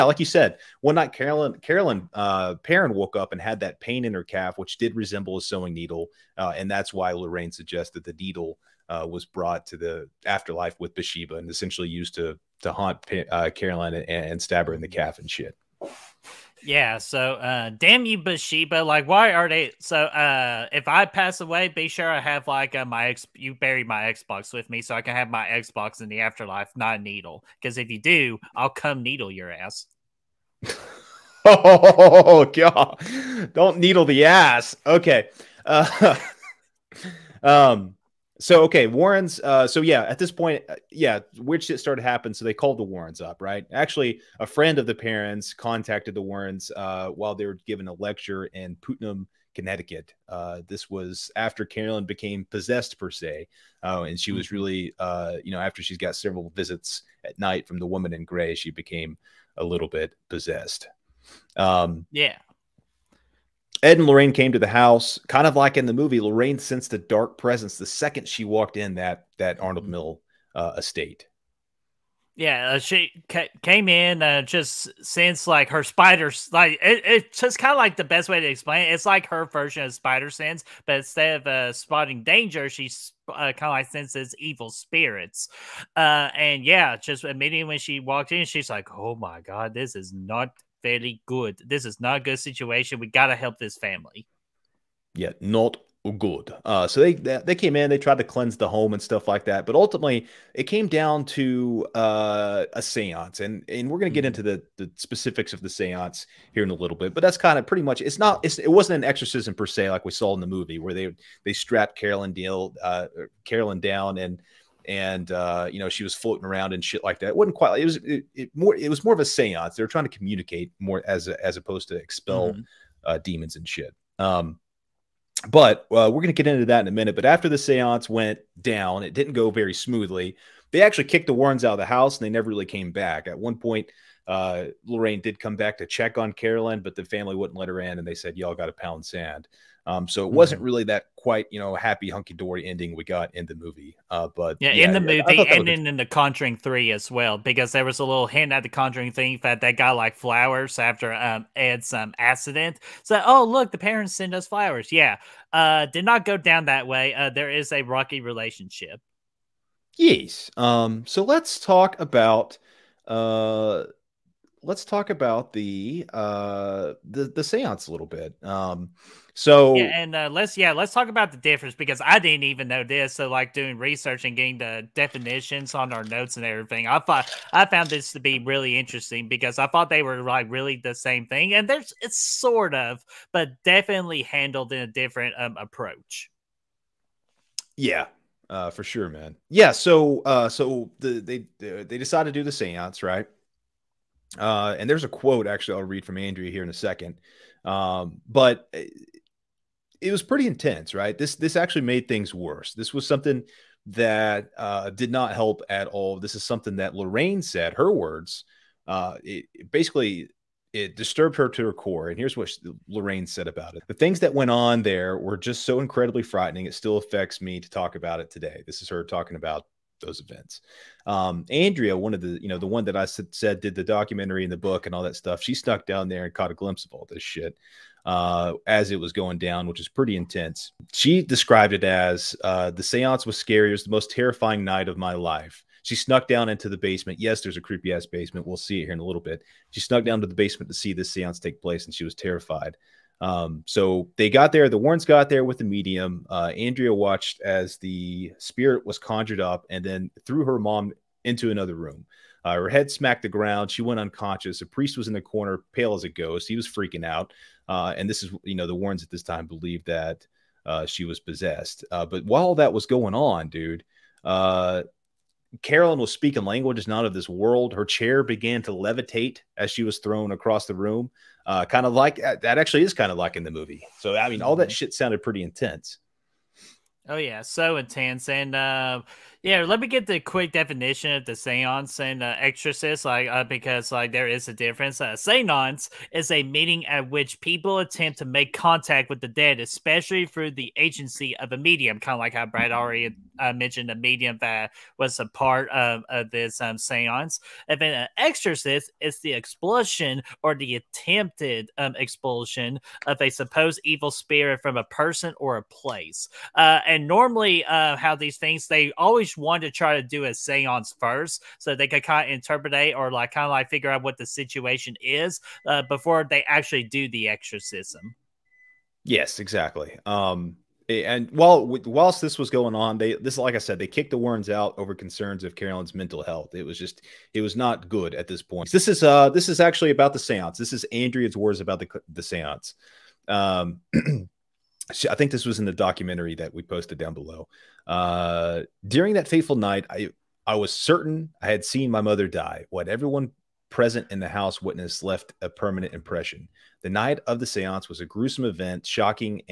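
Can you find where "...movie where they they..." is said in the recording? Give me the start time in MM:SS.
01:50.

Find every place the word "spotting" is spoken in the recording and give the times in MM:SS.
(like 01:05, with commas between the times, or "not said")
01:21.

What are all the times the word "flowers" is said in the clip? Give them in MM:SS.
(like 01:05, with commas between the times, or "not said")
02:30, 02:34.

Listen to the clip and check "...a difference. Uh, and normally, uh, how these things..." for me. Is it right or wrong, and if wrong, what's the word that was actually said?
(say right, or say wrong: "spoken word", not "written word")
wrong: "place", not "difference".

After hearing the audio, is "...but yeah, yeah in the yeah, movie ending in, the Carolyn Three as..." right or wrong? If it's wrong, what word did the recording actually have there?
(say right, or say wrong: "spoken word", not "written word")
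wrong: "Conjuring", not "Carolyn".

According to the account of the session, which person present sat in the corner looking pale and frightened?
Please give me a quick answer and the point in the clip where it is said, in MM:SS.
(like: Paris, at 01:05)
A priest, at 04:14.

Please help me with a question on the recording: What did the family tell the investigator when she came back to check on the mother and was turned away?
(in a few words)
Pound sand.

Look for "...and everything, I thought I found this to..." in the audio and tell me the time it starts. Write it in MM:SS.
02:56.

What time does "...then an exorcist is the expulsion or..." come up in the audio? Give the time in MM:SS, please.
04:57.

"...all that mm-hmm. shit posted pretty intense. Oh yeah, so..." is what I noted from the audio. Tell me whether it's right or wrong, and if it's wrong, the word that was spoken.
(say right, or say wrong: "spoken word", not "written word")
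wrong: "sounded", not "posted".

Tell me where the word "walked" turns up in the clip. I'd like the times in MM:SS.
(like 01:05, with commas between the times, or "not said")
01:08, 01:27.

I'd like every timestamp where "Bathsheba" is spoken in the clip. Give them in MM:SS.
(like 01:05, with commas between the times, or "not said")
00:10, 00:18.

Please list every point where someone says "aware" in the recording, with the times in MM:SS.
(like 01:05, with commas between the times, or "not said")
not said.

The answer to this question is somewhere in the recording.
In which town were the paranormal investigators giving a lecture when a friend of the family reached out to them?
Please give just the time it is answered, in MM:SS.
00:48.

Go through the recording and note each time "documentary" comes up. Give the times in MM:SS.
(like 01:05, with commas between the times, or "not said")
03:43, 05:35.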